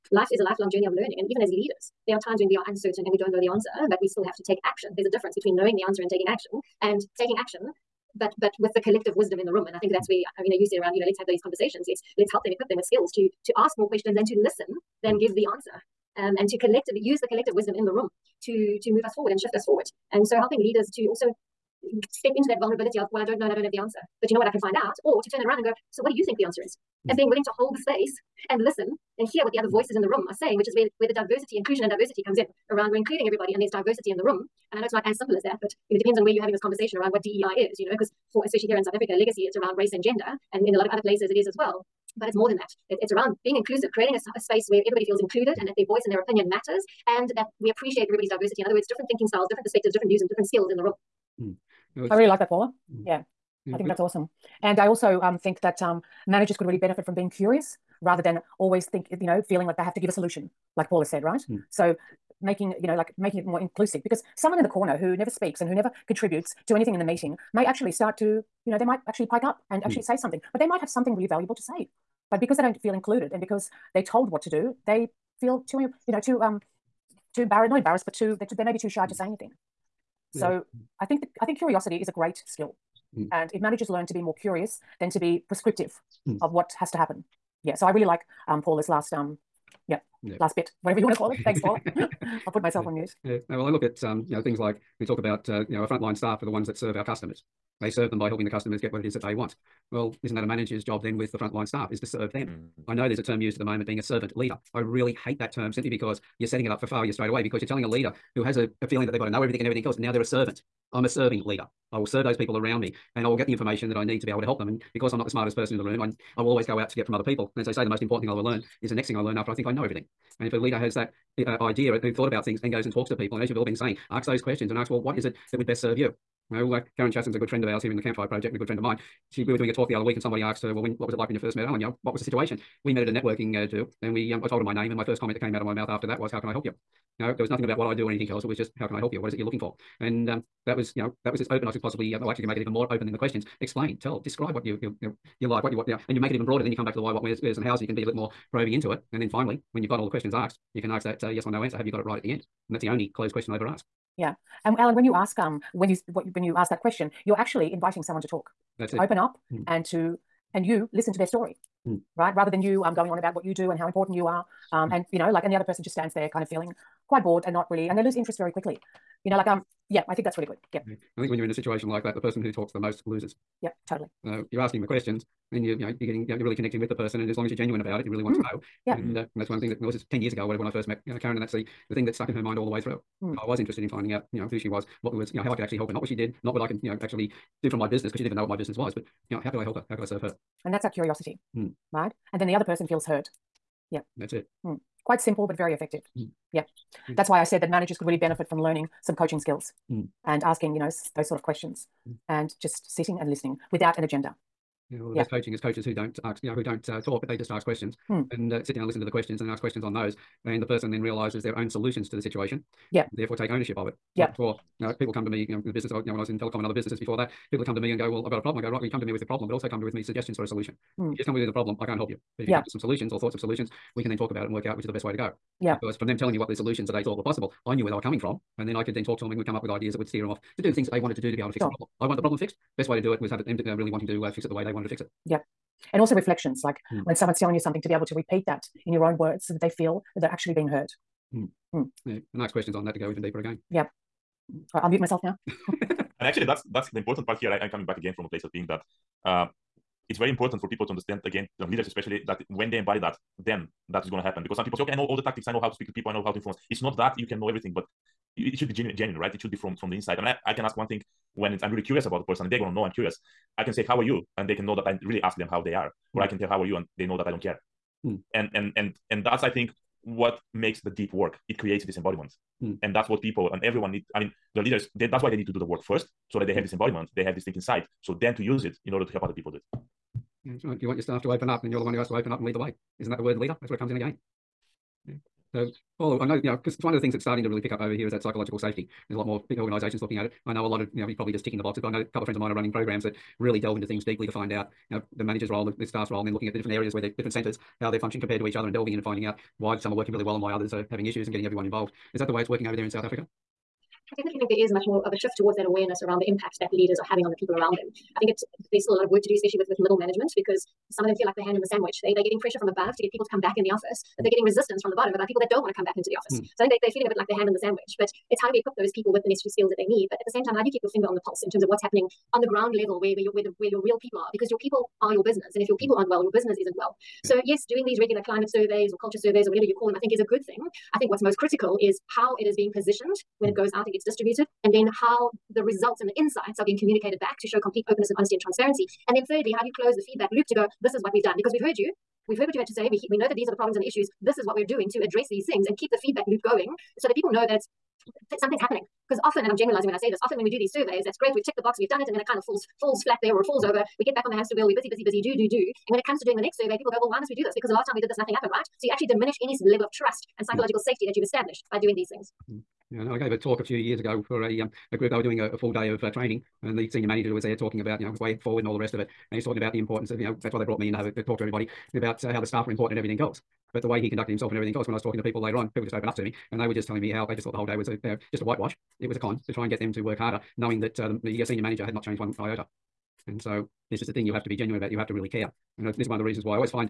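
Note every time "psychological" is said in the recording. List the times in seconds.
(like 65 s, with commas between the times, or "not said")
288 s, 360 s.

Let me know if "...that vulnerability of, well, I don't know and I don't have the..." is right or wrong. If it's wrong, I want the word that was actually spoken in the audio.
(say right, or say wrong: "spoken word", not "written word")
right.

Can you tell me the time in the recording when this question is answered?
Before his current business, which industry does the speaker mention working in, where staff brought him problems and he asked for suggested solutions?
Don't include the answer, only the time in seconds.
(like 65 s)
216 s.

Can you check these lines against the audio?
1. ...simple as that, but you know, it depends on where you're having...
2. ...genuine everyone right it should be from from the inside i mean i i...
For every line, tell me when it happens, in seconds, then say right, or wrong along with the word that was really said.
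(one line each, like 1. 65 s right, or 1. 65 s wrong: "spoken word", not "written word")
1. 35 s right
2. 258 s wrong: "genuine", not "everyone".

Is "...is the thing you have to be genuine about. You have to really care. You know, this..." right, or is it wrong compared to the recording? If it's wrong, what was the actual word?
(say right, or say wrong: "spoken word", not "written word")
right.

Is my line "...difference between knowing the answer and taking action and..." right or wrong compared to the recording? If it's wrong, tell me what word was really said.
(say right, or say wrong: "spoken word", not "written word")
right.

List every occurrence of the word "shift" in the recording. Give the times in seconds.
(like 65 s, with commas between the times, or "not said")
19 s, 305 s.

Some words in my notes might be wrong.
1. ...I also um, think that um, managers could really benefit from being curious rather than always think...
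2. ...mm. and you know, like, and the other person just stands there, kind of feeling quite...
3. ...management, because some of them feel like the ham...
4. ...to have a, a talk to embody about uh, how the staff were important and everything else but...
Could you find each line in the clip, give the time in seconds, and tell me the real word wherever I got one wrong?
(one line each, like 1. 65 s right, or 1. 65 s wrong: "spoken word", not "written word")
1. 54 s right
2. 164 s right
3. 309 s right
4. 370 s wrong: "everybody", not "embody".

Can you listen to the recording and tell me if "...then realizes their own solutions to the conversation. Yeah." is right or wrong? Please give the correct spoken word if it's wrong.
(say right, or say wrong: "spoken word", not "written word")
wrong: "situation", not "conversation".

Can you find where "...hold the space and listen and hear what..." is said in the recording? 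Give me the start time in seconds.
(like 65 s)
27 s.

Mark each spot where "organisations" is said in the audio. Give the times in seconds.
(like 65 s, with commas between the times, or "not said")
289 s.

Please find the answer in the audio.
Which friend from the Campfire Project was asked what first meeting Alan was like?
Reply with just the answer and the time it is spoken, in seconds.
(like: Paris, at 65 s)
Karen Chasson, at 126 s.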